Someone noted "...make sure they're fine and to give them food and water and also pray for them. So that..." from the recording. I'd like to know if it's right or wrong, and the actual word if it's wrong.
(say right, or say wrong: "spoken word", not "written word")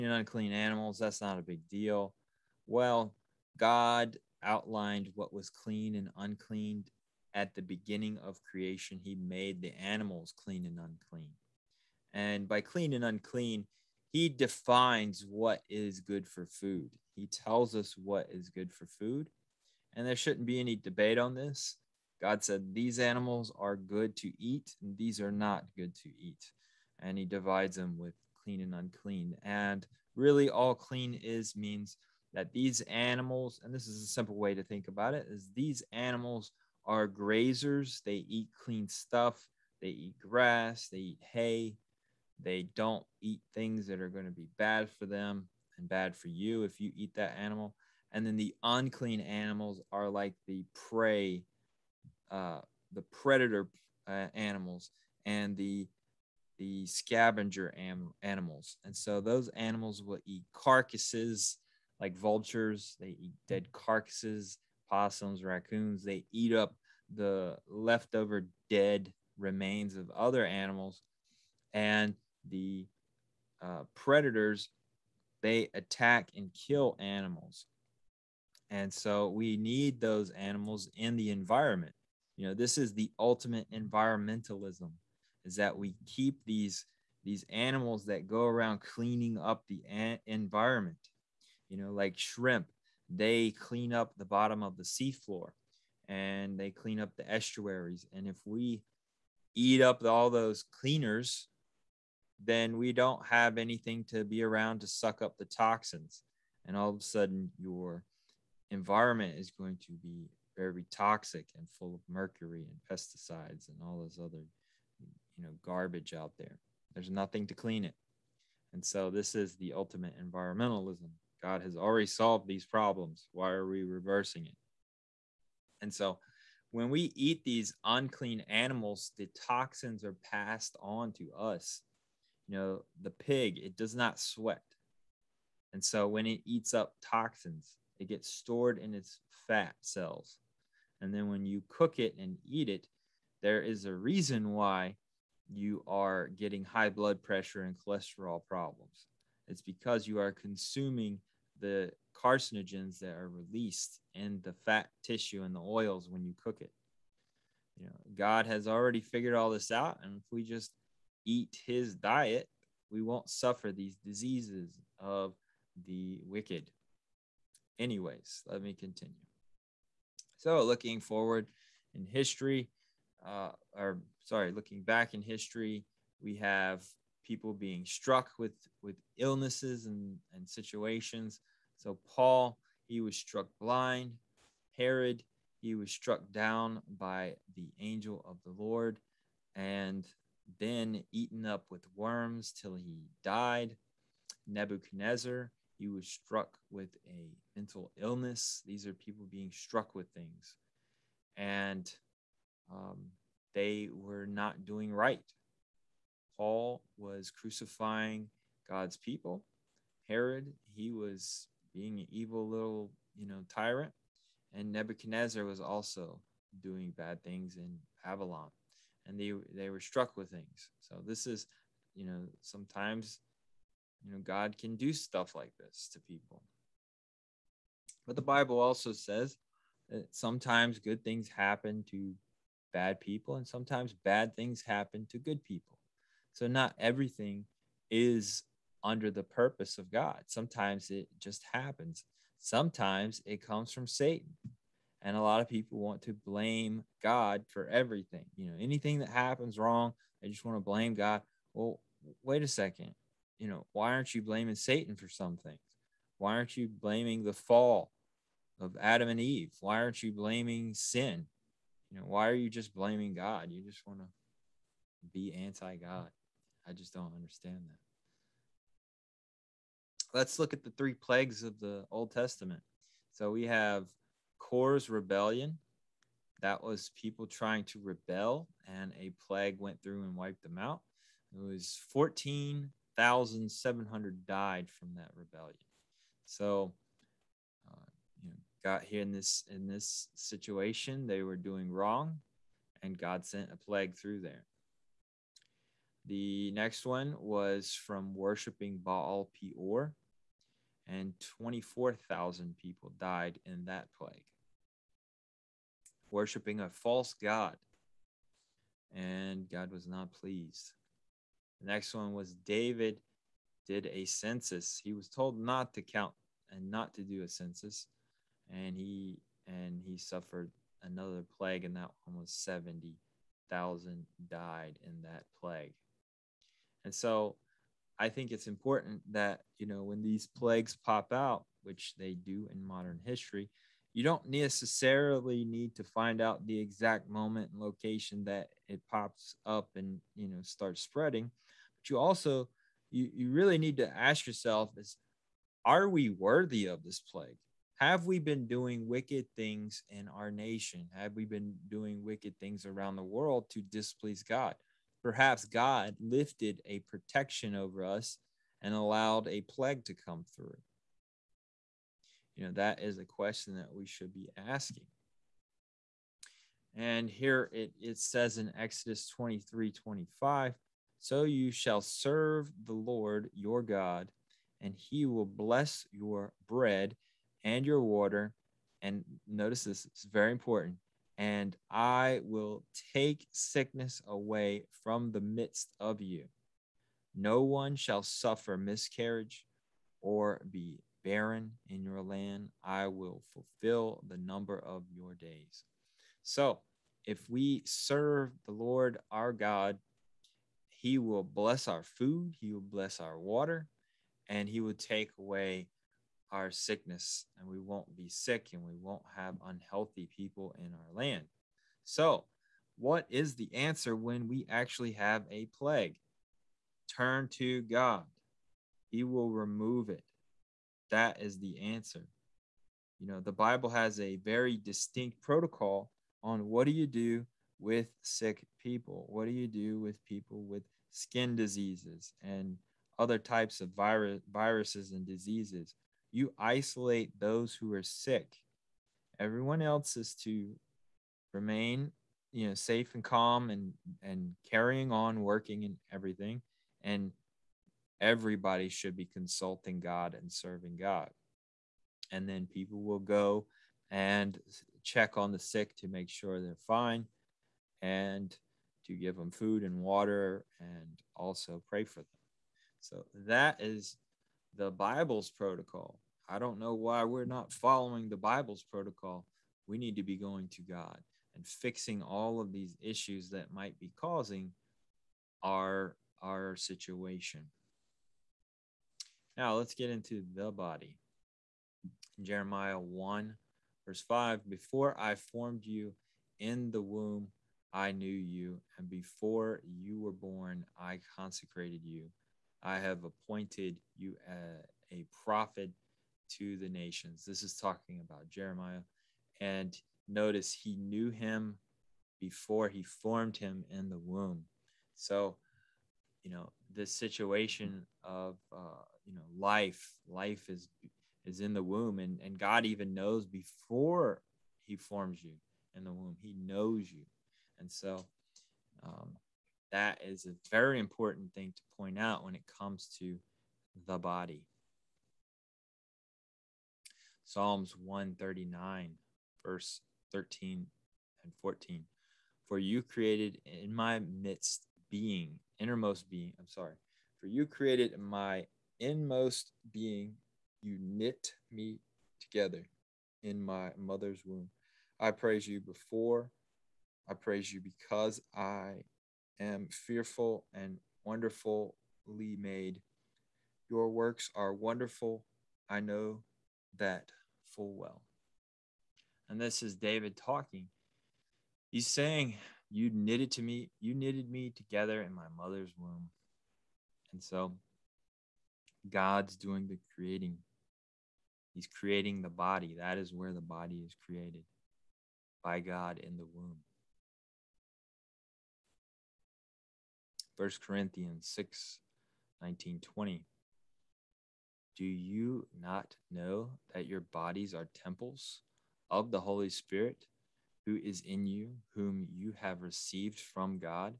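right.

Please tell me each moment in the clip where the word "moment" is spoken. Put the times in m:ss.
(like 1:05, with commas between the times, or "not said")
5:37.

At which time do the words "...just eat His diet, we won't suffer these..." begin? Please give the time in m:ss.
2:40.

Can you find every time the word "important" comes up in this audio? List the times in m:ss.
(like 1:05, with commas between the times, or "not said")
5:28, 6:20, 8:40.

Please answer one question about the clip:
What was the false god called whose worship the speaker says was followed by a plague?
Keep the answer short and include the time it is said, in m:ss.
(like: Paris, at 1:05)
Baal Peor, at 4:58.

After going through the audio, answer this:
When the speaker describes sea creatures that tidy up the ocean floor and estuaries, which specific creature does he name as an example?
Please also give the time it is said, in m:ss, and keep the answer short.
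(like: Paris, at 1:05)
shrimp, at 1:32.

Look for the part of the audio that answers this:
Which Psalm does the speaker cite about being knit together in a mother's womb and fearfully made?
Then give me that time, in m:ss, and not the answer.
8:47.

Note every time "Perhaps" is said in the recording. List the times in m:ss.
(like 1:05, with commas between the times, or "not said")
5:55.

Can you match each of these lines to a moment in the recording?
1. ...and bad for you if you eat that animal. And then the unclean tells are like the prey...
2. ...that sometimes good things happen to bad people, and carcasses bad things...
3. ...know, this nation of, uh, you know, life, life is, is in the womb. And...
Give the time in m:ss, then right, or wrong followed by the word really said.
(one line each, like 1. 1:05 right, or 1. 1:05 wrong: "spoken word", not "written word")
1. 0:45 wrong: "animals", not "tells"
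2. 3:49 wrong: "sometimes", not "carcasses"
3. 8:26 wrong: "situation", not "nation".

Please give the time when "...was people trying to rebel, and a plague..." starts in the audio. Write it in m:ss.
4:36.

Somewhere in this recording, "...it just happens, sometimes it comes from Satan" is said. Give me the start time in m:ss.
4:00.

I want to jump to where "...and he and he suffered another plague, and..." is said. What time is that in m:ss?
5:18.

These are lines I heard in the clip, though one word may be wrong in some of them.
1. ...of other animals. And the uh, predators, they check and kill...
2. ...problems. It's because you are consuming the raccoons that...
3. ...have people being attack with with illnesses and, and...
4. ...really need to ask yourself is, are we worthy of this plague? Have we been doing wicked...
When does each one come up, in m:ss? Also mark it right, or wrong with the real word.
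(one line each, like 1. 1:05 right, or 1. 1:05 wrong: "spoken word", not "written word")
1. 1:09 wrong: "attack", not "check"
2. 2:28 wrong: "carcinogens", not "raccoons"
3. 2:56 wrong: "struck", not "attack"
4. 5:43 right.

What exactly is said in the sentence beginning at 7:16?
you isolate those who are sick.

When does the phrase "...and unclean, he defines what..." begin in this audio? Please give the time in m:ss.
0:12.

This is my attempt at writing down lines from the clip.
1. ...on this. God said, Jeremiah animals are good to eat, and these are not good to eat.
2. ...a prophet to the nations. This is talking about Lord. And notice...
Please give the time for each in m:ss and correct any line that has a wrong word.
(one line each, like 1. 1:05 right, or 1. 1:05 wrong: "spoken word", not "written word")
1. 0:21 wrong: "These", not "Jeremiah"
2. 8:14 wrong: "Jeremiah", not "Lord".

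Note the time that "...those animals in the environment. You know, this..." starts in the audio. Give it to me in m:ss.
1:19.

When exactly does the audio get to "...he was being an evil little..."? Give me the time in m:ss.
3:30.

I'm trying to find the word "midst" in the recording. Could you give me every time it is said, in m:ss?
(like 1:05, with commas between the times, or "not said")
6:25, 8:53.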